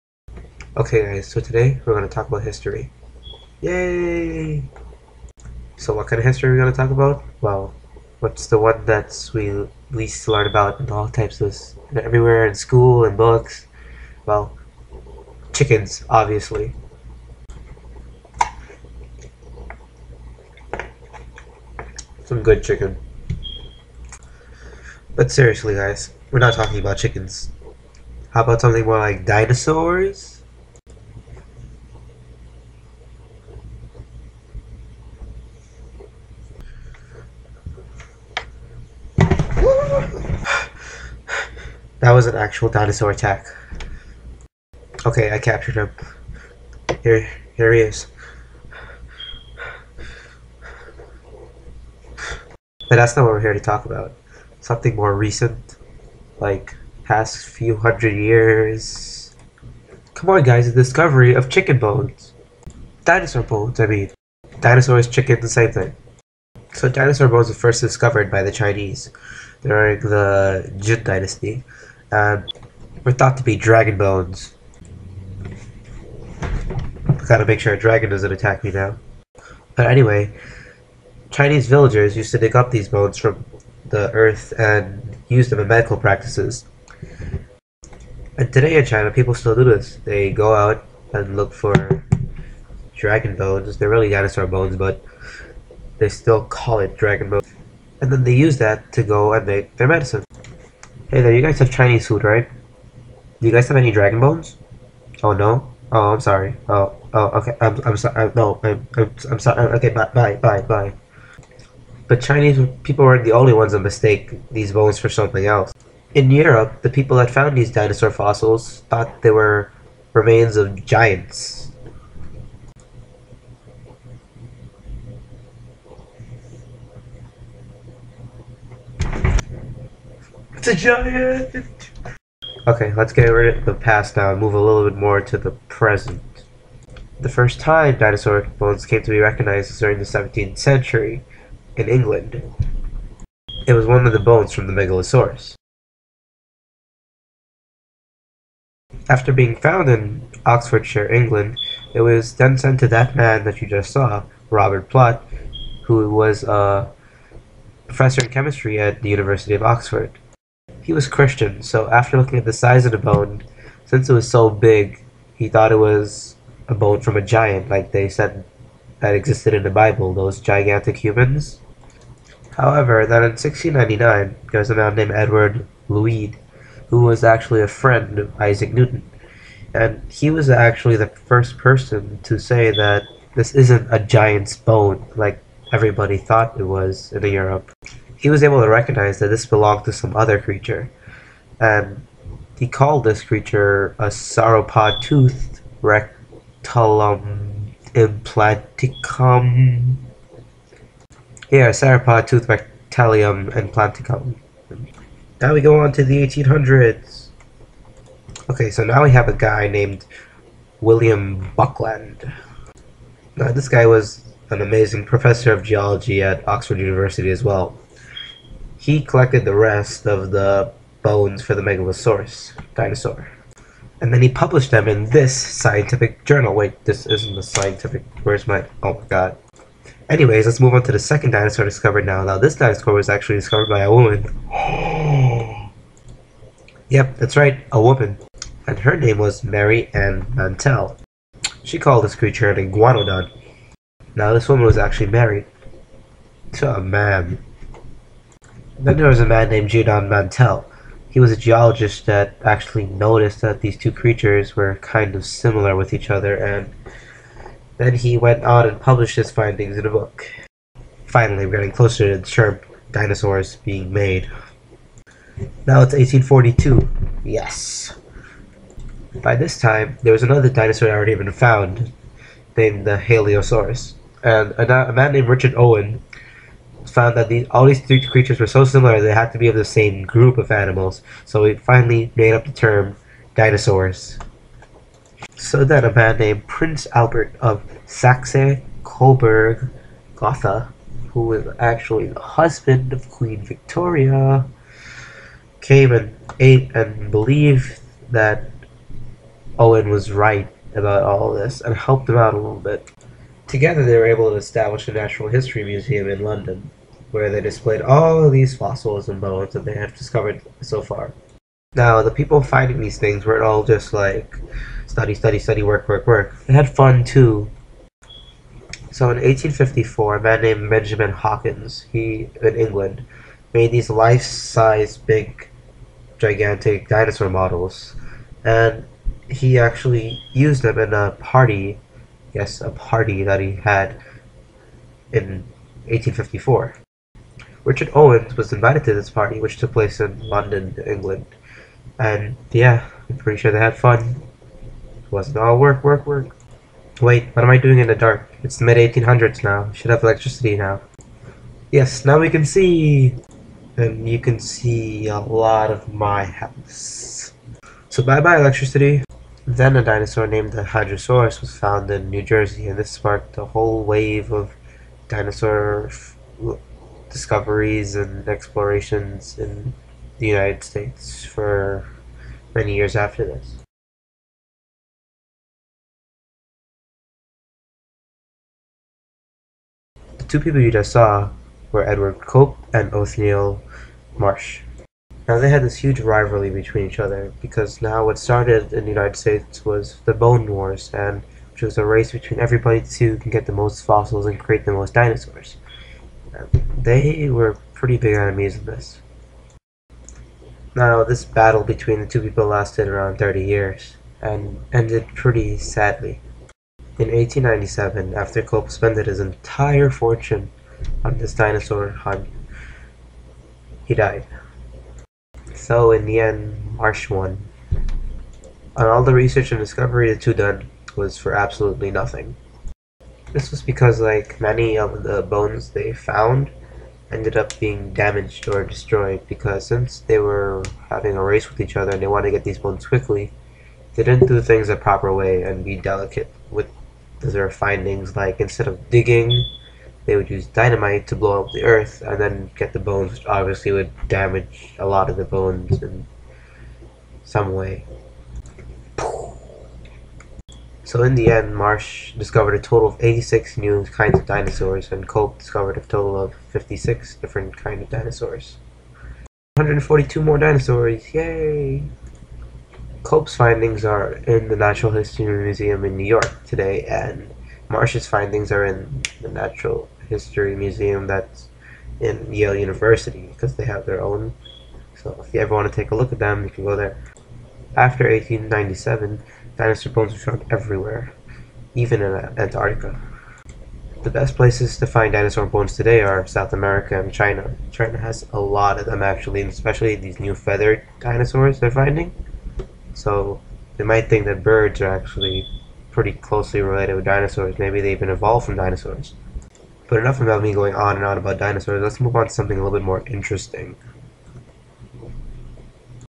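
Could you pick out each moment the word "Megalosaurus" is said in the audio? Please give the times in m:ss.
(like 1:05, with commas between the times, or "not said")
2:24, 3:41.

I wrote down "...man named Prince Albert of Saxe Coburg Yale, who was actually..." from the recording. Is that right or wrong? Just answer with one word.
wrong.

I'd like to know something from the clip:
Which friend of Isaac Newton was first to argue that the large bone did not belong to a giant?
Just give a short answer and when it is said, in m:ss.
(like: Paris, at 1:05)
Edward Lhuyd, at 2:55.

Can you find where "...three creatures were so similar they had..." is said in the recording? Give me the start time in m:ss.
4:37.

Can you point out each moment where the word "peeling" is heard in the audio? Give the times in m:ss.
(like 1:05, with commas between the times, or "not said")
not said.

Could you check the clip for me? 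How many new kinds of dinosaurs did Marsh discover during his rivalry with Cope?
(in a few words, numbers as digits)
86.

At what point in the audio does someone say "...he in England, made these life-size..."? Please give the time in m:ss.
5:21.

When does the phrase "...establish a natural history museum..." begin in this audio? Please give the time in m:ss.
5:04.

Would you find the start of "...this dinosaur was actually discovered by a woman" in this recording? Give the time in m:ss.
3:52.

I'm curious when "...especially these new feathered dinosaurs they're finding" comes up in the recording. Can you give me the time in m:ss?
8:09.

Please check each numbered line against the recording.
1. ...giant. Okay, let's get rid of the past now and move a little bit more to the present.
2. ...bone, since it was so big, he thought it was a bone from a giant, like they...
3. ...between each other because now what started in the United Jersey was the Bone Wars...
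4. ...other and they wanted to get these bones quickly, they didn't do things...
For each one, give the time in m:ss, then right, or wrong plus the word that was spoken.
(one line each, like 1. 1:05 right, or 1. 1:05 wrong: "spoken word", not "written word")
1. 2:10 right
2. 2:42 right
3. 6:26 wrong: "States", not "Jersey"
4. 7:11 right.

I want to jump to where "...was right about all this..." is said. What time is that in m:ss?
4:59.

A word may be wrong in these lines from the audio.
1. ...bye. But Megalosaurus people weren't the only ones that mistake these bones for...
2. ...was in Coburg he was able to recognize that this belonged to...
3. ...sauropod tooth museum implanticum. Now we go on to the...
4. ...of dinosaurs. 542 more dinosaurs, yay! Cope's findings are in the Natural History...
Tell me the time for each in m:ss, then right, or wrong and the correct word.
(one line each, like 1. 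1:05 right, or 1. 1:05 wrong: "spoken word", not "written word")
1. 1:50 wrong: "Chinese", not "Megalosaurus"
2. 3:06 wrong: "Europe", not "Coburg"
3. 3:21 wrong: "rectalium", not "museum"
4. 7:37 wrong: "142", not "542".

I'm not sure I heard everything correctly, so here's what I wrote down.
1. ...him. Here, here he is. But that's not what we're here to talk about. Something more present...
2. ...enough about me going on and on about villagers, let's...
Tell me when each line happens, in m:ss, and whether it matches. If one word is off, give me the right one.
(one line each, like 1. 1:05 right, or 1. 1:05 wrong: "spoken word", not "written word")
1. 0:45 wrong: "recent", not "present"
2. 8:19 wrong: "dinosaurs", not "villagers".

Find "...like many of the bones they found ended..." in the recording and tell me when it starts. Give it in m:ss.
7:04.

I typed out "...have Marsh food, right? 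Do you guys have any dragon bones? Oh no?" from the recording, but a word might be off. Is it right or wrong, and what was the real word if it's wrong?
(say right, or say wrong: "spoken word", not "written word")
wrong: "Chinese", not "Marsh".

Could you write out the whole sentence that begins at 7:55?
So if you ever want to take a look at them, you can go there.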